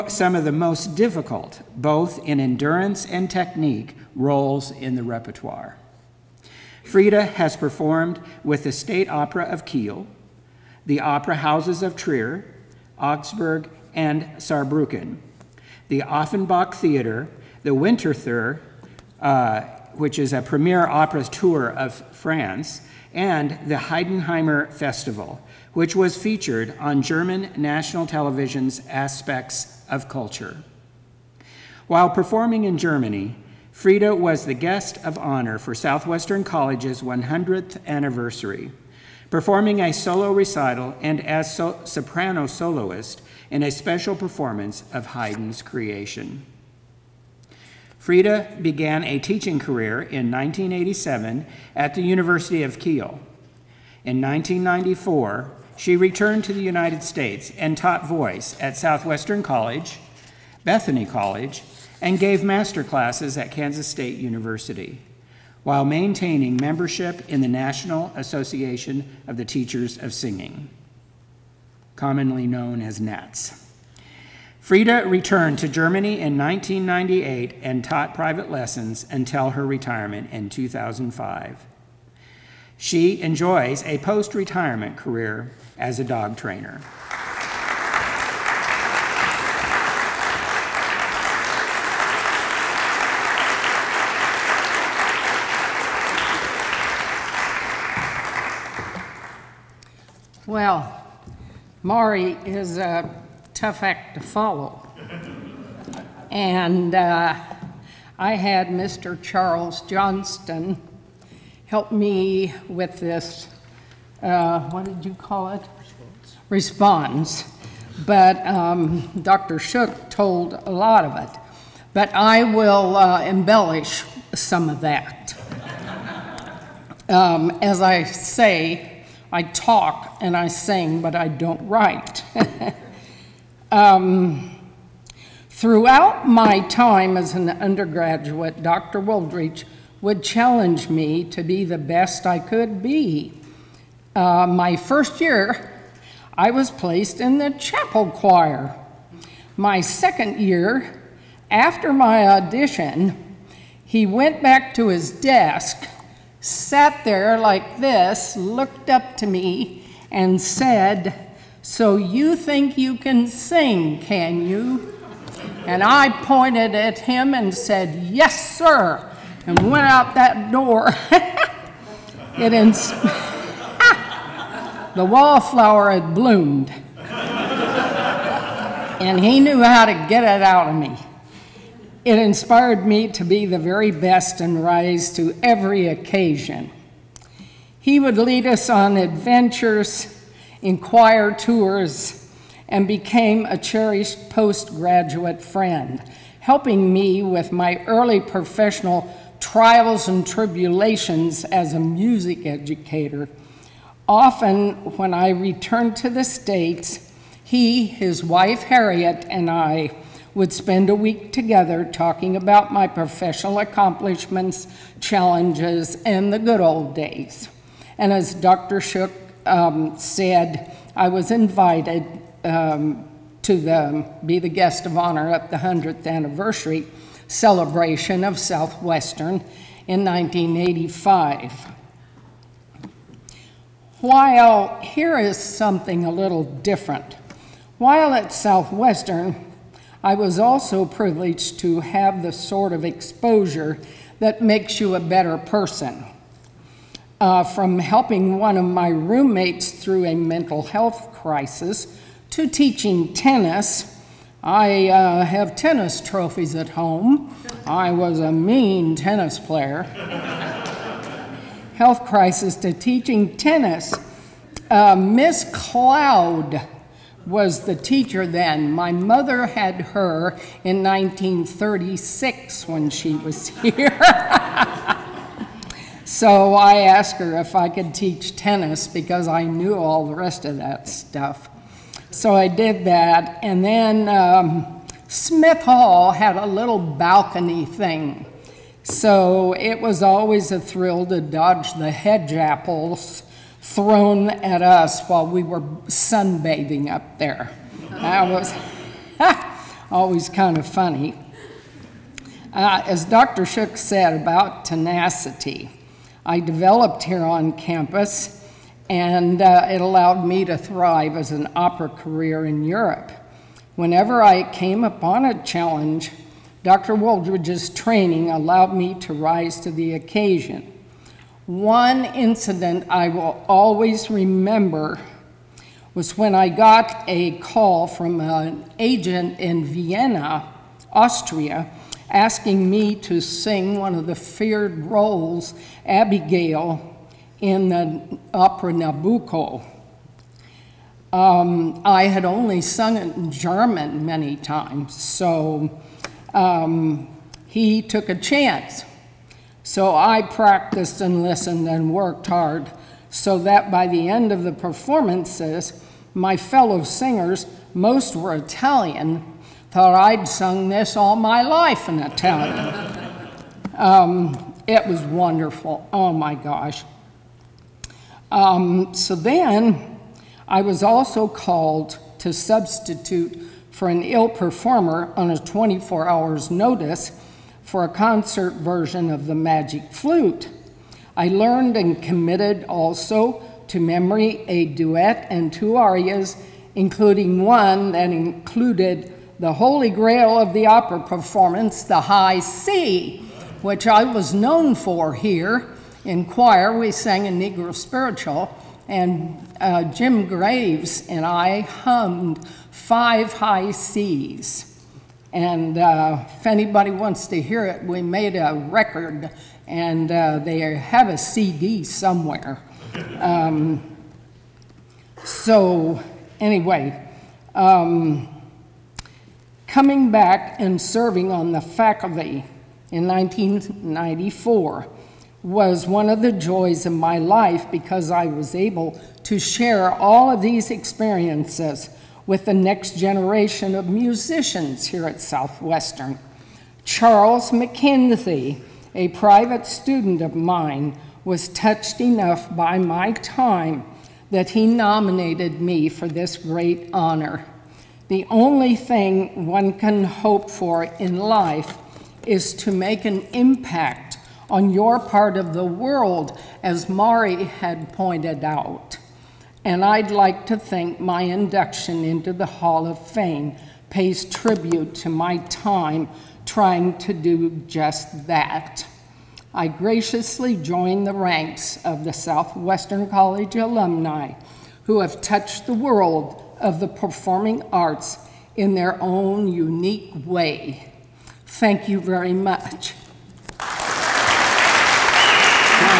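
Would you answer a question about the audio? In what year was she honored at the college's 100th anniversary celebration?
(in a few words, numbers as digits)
1985.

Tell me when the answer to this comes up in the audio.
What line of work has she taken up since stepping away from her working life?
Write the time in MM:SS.
01:26.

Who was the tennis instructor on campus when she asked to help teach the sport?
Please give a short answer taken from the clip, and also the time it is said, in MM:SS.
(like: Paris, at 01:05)
Miss Cloud, at 04:24.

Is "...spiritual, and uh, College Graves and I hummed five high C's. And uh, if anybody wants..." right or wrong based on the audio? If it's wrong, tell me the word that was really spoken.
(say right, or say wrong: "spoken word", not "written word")
wrong: "Jim", not "College".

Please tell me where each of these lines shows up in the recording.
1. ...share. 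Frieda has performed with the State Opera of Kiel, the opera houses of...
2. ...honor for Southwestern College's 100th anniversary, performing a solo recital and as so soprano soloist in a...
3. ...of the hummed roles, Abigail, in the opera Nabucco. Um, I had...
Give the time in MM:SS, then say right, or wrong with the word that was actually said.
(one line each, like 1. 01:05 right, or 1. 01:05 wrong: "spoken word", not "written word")
1. 00:05 wrong: "repertoire", not "share"
2. 00:35 right
3. 05:33 wrong: "feared", not "hummed".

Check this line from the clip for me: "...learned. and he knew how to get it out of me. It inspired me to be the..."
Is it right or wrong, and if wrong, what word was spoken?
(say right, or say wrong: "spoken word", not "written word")
wrong: "bloomed", not "learned".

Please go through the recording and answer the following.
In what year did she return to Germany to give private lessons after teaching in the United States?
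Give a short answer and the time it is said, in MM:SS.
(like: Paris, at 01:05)
1998, at 01:16.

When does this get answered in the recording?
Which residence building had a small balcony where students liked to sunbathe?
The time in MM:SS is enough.
04:45.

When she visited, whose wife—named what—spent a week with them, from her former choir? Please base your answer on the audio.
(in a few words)
Harriet.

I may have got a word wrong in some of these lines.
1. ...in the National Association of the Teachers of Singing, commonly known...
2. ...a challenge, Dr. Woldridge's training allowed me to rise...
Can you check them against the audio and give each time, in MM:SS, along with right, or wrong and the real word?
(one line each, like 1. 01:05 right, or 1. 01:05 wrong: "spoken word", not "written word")
1. 01:07 right
2. 05:15 right.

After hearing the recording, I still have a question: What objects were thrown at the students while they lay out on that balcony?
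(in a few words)
Hedge apples.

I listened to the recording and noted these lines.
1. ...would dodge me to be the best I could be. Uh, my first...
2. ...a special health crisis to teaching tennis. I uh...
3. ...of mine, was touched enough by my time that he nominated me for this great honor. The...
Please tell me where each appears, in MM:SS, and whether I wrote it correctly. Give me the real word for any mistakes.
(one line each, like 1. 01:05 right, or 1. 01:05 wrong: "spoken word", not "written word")
1. 02:20 wrong: "challenge", not "dodge"
2. 04:10 wrong: "mental", not "special"
3. 07:20 right.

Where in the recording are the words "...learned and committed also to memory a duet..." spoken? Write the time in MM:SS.
06:21.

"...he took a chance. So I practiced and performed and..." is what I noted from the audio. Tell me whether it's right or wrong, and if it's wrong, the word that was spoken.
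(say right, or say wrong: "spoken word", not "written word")
wrong: "listened", not "performed".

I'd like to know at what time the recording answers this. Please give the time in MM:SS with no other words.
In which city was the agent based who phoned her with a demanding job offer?
05:29.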